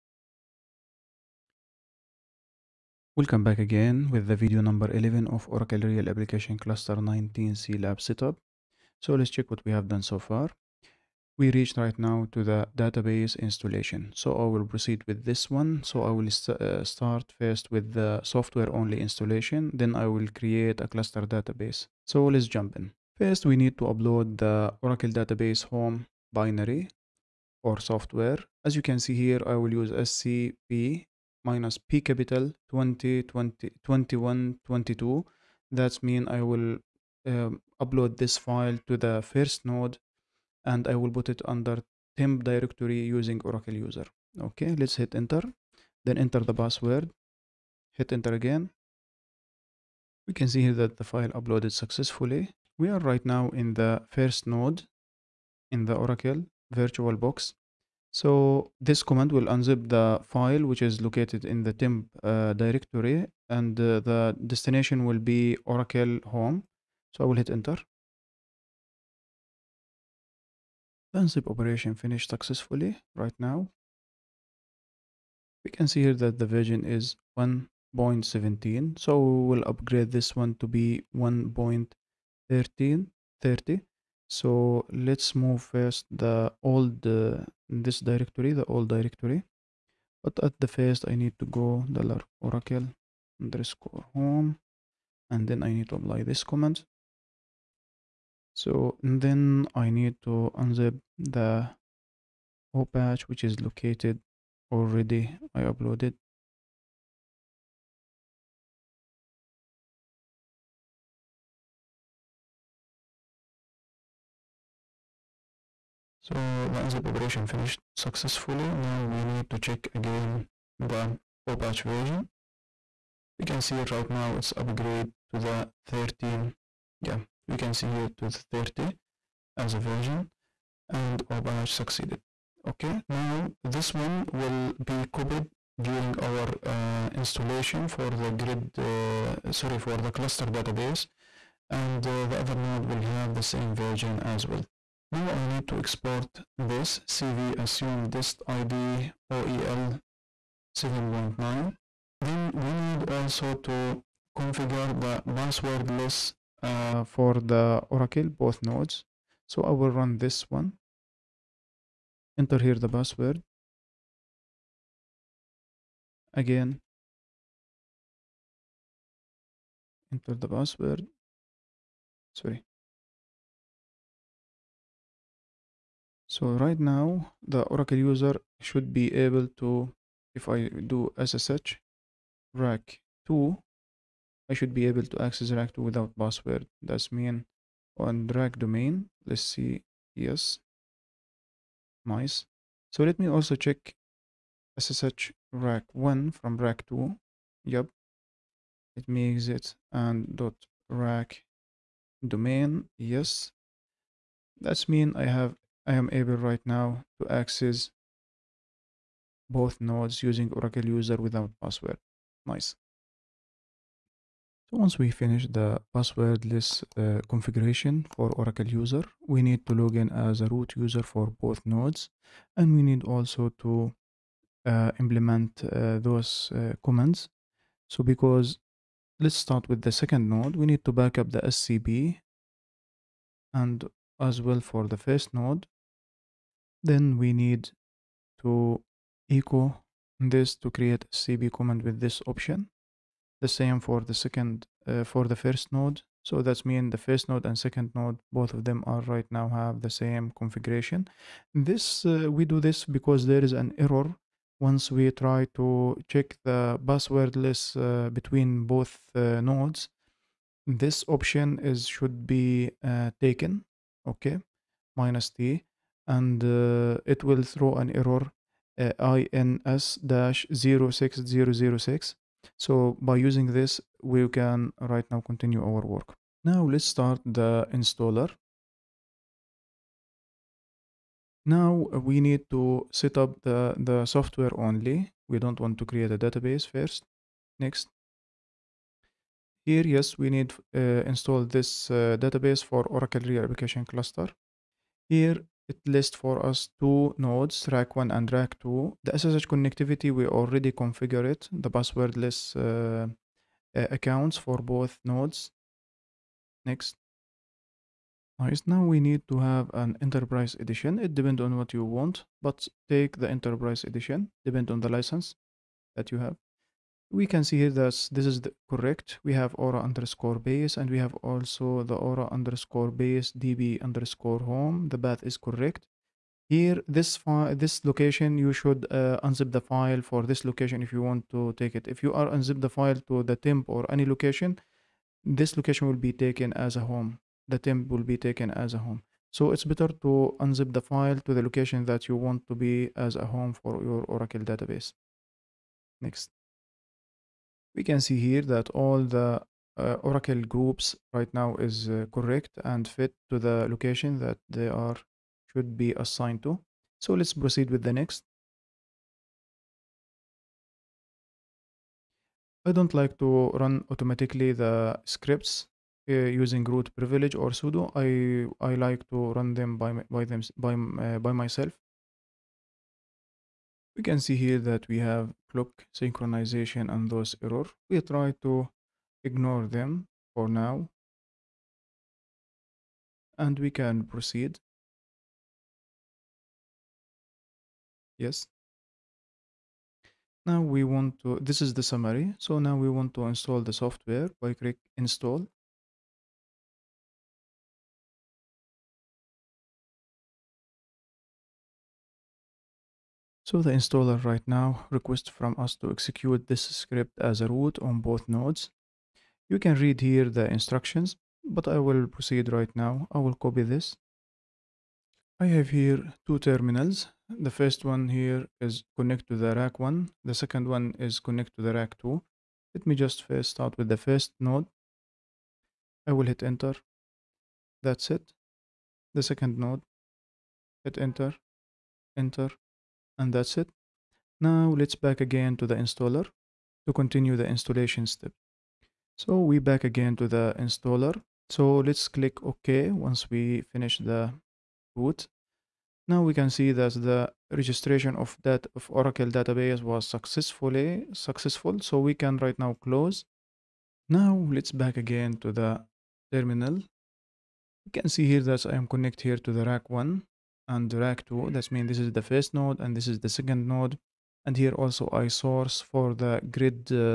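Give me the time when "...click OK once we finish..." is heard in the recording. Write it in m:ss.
7:22.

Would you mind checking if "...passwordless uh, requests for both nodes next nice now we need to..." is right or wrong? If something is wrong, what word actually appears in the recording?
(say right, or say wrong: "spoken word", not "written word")
wrong: "accounts", not "requests".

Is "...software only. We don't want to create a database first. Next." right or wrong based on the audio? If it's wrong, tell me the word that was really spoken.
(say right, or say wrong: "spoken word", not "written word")
right.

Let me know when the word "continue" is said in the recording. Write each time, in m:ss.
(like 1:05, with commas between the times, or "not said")
4:35, 7:16.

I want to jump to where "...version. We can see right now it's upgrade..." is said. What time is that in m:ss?
2:01.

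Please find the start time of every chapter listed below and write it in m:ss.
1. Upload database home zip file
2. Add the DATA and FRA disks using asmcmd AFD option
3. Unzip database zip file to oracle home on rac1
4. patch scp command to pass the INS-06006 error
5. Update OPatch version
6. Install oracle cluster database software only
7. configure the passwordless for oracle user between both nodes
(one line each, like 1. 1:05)
1. 0:23
2. 7:34
3. 0:58
4. 3:33
5. 1:14
6. 4:47
7. 2:25.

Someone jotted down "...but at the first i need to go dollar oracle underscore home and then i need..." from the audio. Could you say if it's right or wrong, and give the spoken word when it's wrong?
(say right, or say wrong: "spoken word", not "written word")
right.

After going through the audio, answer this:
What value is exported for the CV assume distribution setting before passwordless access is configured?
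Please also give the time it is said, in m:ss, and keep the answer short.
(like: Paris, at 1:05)
OEL 7.9, at 2:29.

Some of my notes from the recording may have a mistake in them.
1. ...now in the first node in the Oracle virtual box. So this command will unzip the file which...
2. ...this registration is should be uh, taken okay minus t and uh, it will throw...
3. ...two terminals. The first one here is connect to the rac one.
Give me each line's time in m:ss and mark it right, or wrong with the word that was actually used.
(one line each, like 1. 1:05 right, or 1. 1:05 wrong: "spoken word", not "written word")
1. 0:53 right
2. 4:20 wrong: "option", not "registration"
3. 6:56 right.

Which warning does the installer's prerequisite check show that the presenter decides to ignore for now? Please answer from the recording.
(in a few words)
clock synchronization.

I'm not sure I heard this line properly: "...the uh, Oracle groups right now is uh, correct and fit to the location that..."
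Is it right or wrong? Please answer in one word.
right.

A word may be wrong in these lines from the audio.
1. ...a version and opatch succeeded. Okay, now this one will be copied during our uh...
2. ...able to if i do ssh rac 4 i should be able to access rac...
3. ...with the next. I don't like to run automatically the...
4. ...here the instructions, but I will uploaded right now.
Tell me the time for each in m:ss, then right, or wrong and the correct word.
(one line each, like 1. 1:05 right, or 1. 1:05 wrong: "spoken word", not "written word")
1. 2:09 right
2. 2:59 wrong: "2", not "4"
3. 5:57 right
4. 6:50 wrong: "proceed", not "uploaded".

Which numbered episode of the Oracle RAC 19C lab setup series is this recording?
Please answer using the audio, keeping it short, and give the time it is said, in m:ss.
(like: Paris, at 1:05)
11, at 0:04.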